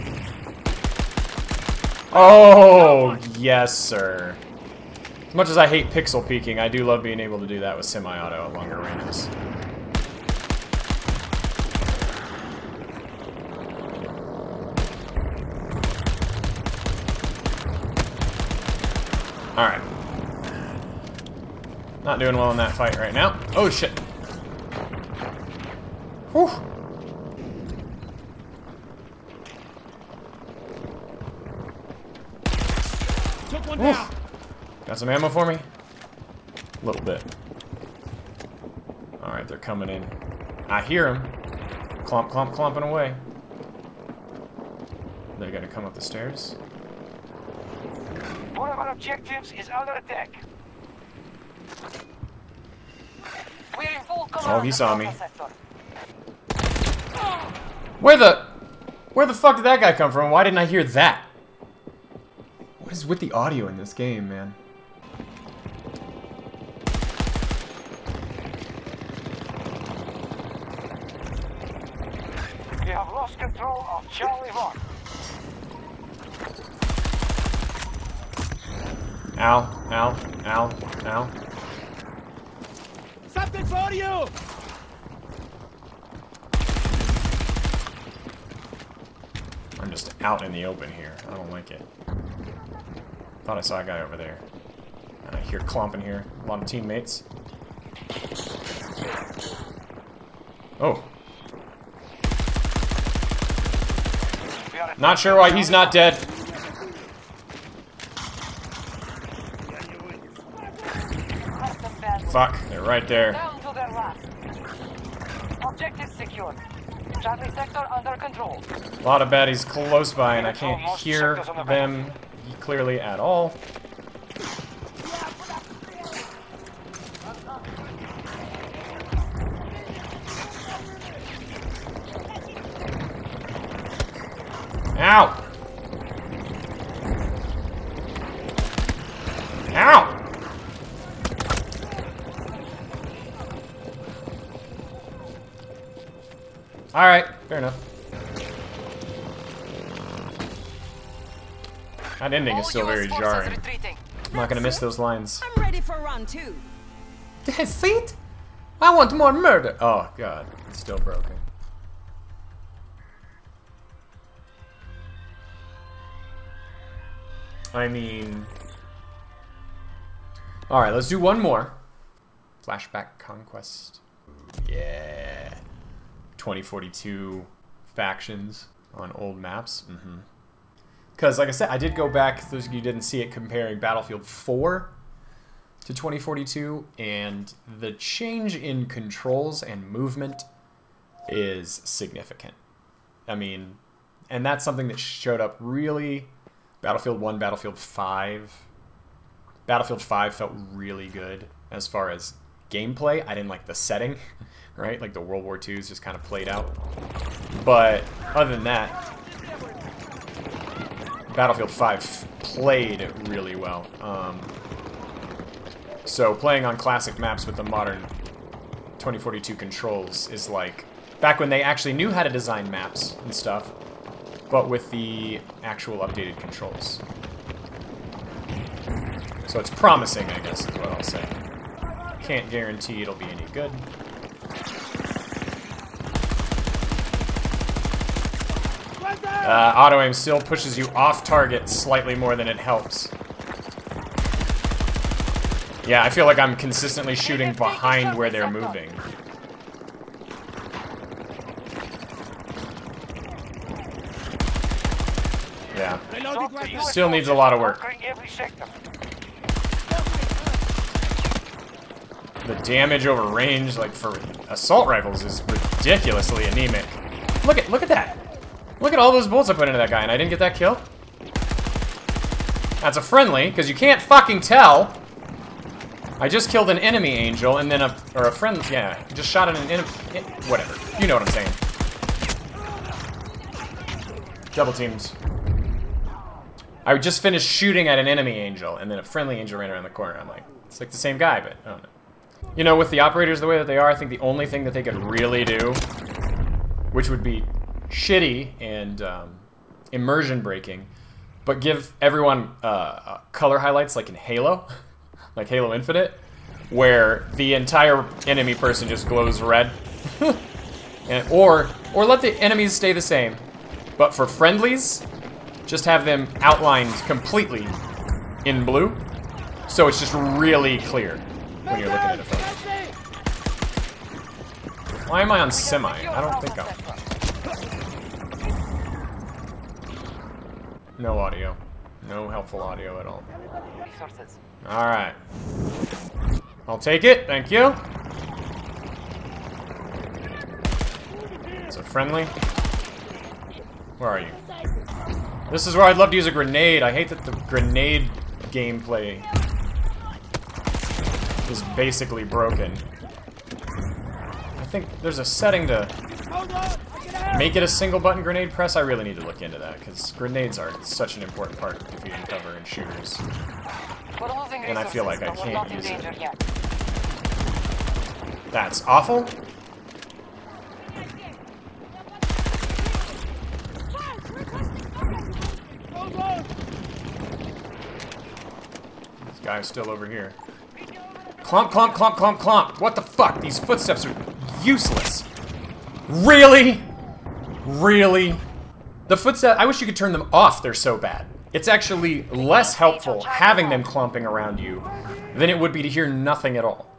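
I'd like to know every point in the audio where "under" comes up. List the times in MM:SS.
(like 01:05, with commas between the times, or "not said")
00:49, 01:57.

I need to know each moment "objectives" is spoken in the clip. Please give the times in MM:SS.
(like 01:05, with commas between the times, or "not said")
00:48, 01:55.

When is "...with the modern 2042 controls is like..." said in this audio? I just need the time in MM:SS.
03:37.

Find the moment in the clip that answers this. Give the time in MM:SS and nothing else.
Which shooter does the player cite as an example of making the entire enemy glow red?
05:05.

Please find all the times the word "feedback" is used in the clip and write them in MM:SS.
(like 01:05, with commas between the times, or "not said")
not said.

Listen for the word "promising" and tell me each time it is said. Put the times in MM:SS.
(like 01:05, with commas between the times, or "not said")
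03:49.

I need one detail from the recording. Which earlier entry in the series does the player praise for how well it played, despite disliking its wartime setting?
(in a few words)
Battlefield 5.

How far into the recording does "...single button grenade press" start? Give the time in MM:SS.
05:57.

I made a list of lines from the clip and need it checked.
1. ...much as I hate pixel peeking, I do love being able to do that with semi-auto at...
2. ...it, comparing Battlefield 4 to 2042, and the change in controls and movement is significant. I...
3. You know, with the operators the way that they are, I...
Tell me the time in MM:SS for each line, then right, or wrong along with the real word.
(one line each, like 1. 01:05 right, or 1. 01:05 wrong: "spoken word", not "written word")
1. 00:05 right
2. 03:03 right
3. 04:52 right.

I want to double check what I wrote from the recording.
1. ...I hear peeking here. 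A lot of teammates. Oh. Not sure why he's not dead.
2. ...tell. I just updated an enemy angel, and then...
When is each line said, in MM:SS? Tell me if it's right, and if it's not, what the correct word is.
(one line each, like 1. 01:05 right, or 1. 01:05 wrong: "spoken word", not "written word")
1. 01:35 wrong: "clomping", not "peeking"
2. 04:34 wrong: "killed", not "updated".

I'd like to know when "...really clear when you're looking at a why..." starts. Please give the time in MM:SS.
05:20.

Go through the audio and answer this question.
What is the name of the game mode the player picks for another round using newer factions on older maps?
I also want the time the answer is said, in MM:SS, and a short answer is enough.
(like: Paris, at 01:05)
Flashback Conquest, at 02:52.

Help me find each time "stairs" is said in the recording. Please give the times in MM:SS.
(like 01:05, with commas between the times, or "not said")
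00:46.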